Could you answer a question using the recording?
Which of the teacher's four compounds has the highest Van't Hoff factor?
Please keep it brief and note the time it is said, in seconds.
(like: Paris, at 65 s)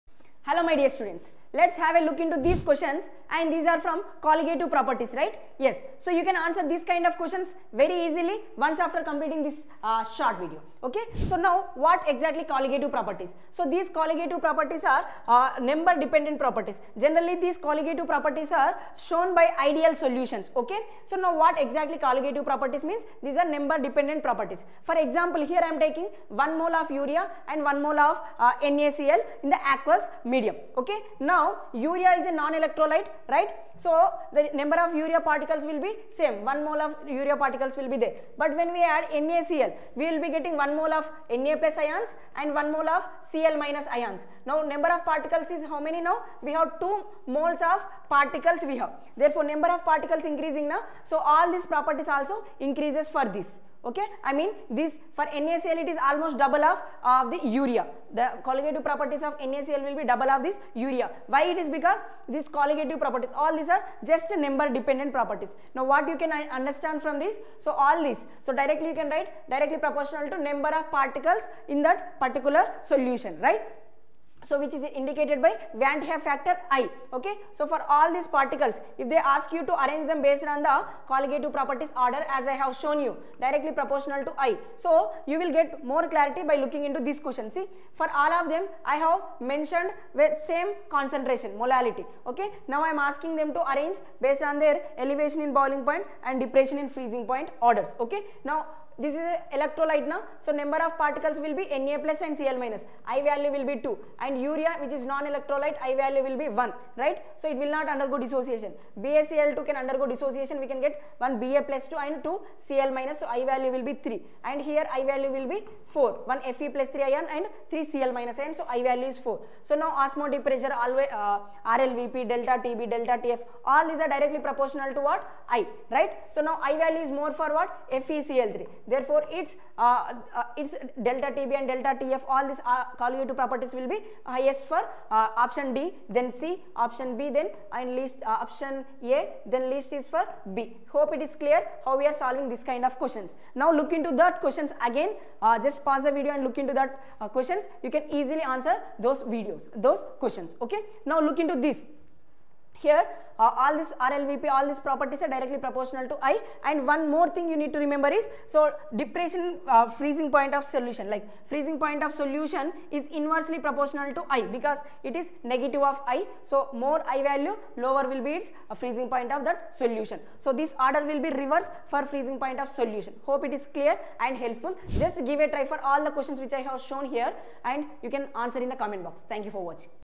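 FeCl3, at 128 s.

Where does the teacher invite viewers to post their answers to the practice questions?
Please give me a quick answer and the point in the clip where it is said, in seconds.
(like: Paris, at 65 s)
the comment box, at 178 s.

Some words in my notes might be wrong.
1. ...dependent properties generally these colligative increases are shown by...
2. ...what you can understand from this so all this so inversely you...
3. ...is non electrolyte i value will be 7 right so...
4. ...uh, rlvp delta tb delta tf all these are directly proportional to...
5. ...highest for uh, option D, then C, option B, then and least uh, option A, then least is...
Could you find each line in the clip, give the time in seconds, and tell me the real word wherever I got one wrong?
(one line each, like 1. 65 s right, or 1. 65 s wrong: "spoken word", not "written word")
1. 16 s wrong: "properties", not "increases"
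2. 65 s wrong: "directly", not "inversely"
3. 104 s wrong: "1", not "7"
4. 121 s right
5. 134 s right.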